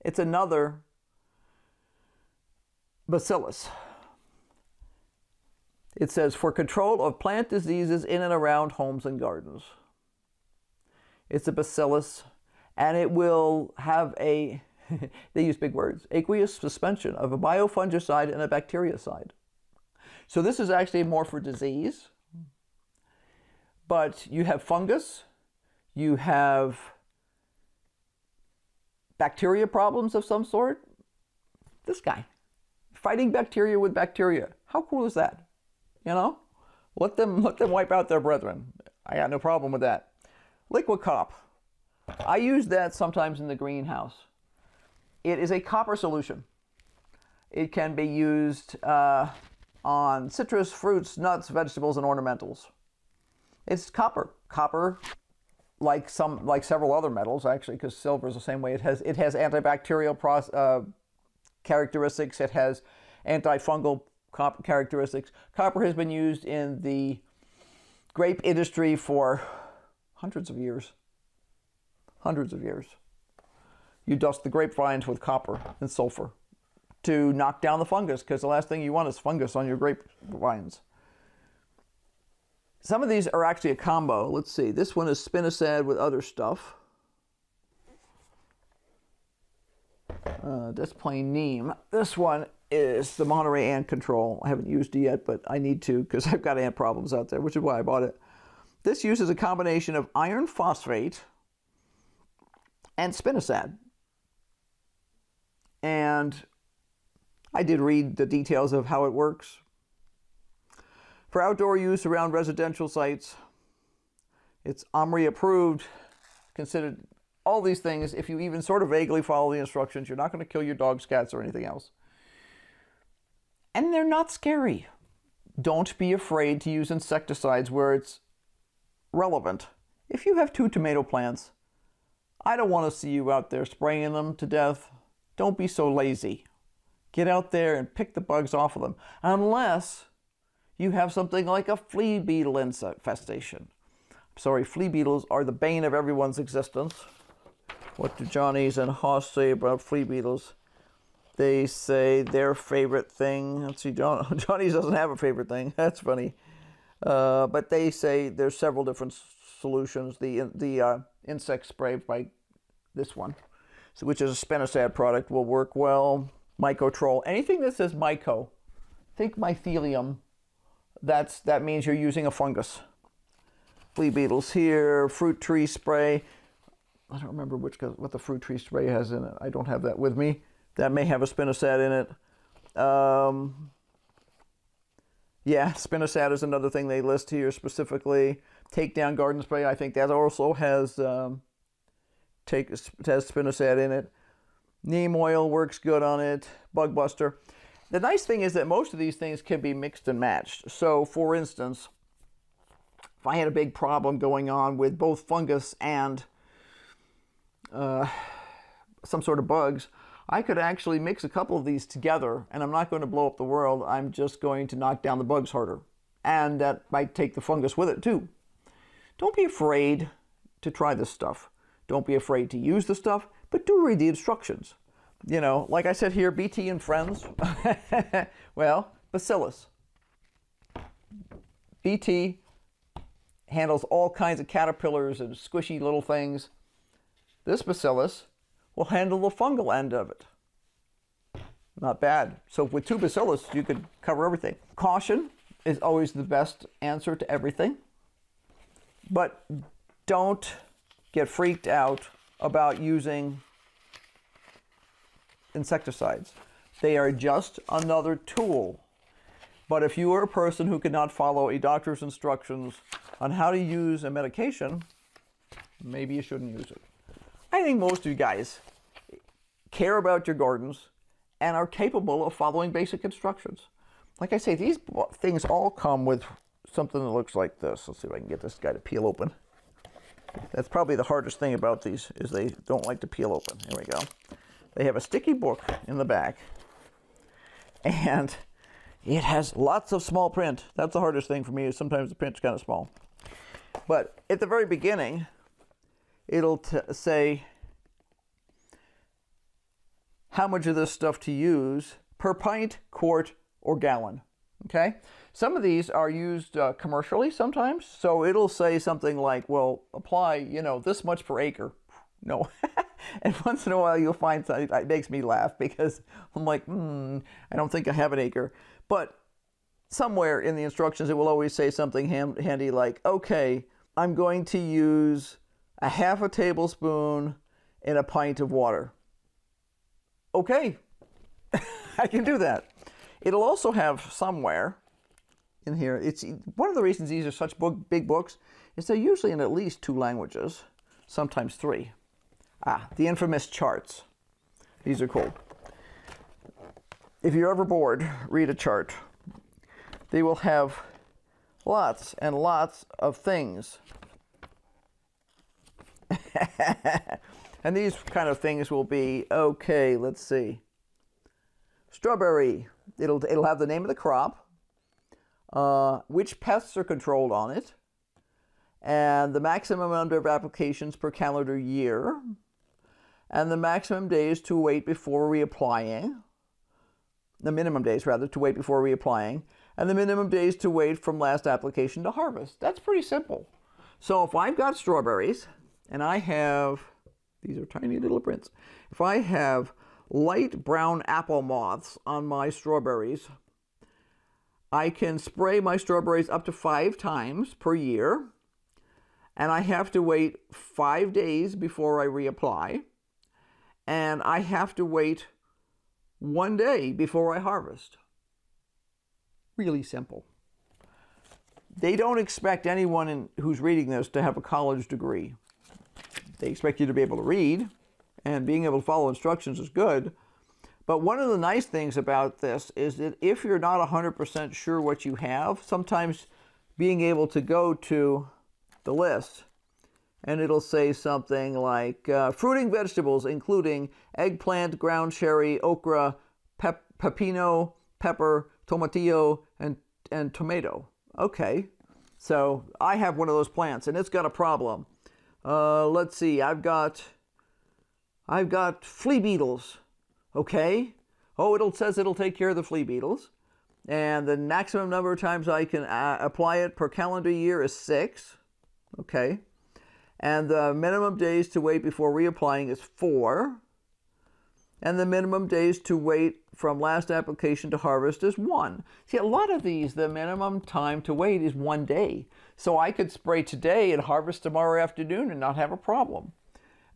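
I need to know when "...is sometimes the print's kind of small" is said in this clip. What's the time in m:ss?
4:51.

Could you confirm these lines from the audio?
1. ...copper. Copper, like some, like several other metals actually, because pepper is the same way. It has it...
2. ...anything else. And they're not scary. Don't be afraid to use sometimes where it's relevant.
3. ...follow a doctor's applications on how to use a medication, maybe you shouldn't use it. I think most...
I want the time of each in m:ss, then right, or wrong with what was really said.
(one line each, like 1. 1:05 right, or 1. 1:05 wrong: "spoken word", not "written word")
1. 0:53 wrong: "silver", not "pepper"
2. 2:01 wrong: "insecticides", not "sometimes"
3. 4:21 wrong: "instructions", not "applications".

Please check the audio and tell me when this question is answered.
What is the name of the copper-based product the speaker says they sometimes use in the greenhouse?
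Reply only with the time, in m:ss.
0:40.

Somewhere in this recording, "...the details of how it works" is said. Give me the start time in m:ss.
1:48.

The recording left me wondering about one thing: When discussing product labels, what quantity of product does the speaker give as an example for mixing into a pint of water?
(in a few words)
half a tablespoon.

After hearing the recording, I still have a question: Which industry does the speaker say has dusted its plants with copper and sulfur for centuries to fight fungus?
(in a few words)
grape industry.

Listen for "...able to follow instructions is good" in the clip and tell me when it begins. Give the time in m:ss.
6:58.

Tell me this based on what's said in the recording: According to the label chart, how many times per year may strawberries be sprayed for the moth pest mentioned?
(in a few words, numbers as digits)
5.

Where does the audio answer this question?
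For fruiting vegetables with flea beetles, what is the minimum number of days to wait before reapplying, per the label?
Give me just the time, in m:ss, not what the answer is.
7:42.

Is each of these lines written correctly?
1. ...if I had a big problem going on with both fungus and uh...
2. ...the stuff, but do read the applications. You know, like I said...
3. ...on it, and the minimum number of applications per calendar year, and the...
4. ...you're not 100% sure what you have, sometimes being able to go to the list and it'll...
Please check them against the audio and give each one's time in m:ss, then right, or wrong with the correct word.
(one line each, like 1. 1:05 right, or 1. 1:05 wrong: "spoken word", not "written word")
1. 3:23 right
2. 3:42 wrong: "instructions", not "applications"
3. 6:07 wrong: "maximum", not "minimum"
4. 7:03 right.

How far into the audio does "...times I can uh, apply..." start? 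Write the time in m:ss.
7:35.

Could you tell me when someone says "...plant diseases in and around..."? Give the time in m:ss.
0:07.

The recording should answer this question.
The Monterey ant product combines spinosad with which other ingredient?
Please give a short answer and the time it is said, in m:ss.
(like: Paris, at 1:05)
iron phosphate, at 1:40.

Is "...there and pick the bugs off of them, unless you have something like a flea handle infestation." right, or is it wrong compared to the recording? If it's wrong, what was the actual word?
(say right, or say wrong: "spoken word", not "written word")
wrong: "beetle", not "handle".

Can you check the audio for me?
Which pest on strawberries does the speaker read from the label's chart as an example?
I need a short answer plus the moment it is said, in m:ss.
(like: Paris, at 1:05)
light brown apple moths, at 6:30.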